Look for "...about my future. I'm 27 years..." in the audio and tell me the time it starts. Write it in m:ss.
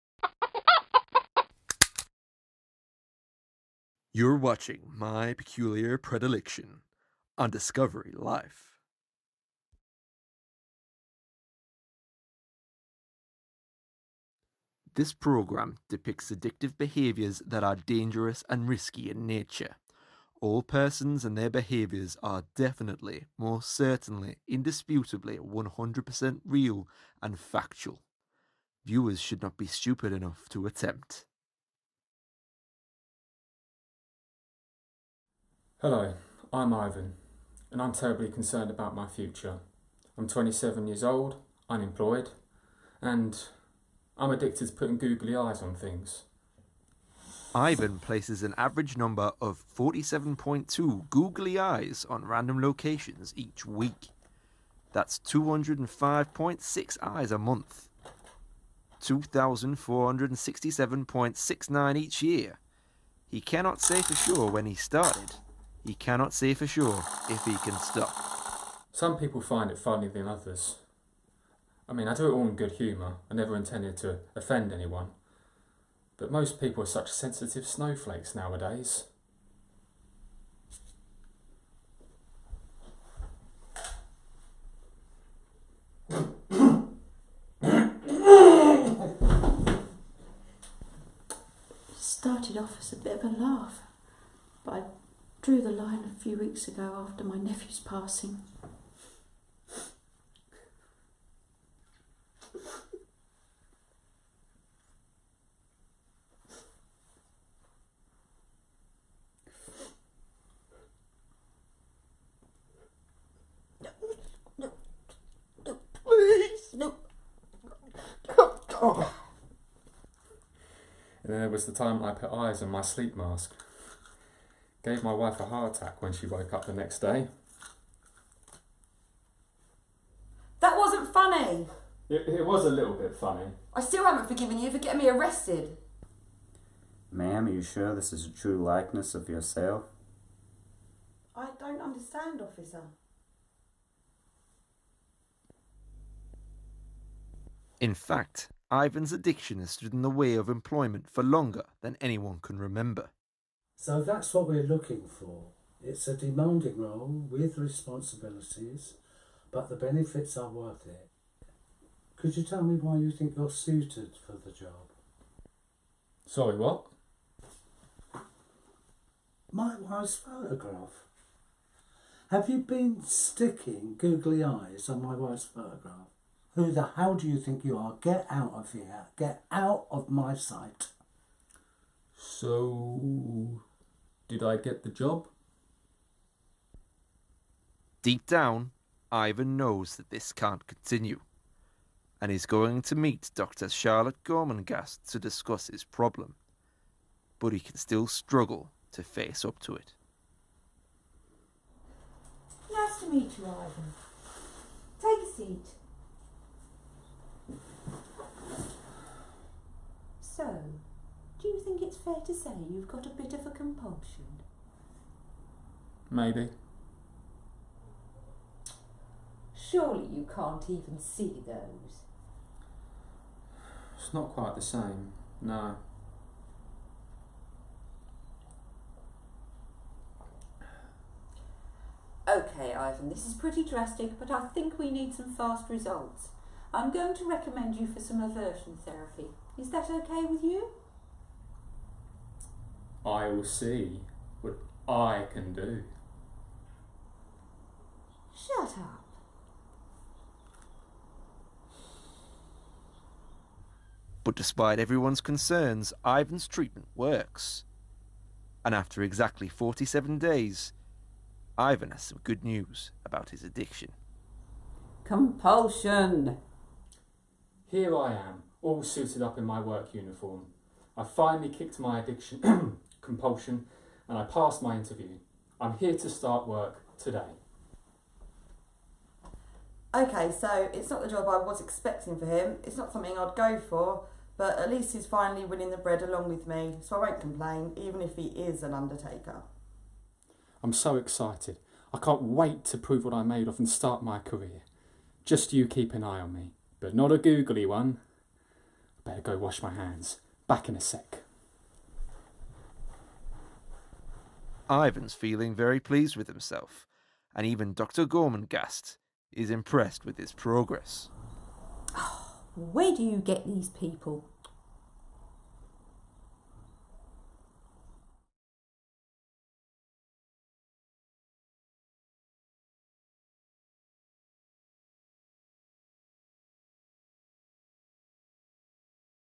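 0:38.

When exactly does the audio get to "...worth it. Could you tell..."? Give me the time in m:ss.
2:40.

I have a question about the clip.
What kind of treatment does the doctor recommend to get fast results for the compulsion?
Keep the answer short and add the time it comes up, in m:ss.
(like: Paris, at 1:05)
aversion therapy, at 3:58.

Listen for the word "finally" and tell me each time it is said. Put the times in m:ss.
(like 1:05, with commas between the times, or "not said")
4:31, 4:45.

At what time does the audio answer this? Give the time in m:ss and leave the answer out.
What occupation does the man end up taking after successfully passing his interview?
4:48.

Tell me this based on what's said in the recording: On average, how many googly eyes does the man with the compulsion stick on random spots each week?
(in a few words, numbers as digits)
47.2.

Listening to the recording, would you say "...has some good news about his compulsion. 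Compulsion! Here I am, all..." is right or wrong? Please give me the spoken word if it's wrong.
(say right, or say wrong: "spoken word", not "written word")
wrong: "addiction", not "compulsion".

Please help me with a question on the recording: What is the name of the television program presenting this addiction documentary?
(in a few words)
My Peculiar Predilection.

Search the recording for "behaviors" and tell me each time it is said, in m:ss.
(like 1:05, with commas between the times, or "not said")
0:16, 0:21.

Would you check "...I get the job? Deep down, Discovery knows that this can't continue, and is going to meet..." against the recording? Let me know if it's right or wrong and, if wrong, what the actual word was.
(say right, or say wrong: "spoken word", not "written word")
wrong: "Ivan", not "Discovery".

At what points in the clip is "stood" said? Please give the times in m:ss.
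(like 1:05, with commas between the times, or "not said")
2:29.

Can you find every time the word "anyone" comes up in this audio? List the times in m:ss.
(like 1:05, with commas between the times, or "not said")
1:14, 2:32.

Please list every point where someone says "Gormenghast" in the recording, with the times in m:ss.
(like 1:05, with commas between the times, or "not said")
3:14, 5:08.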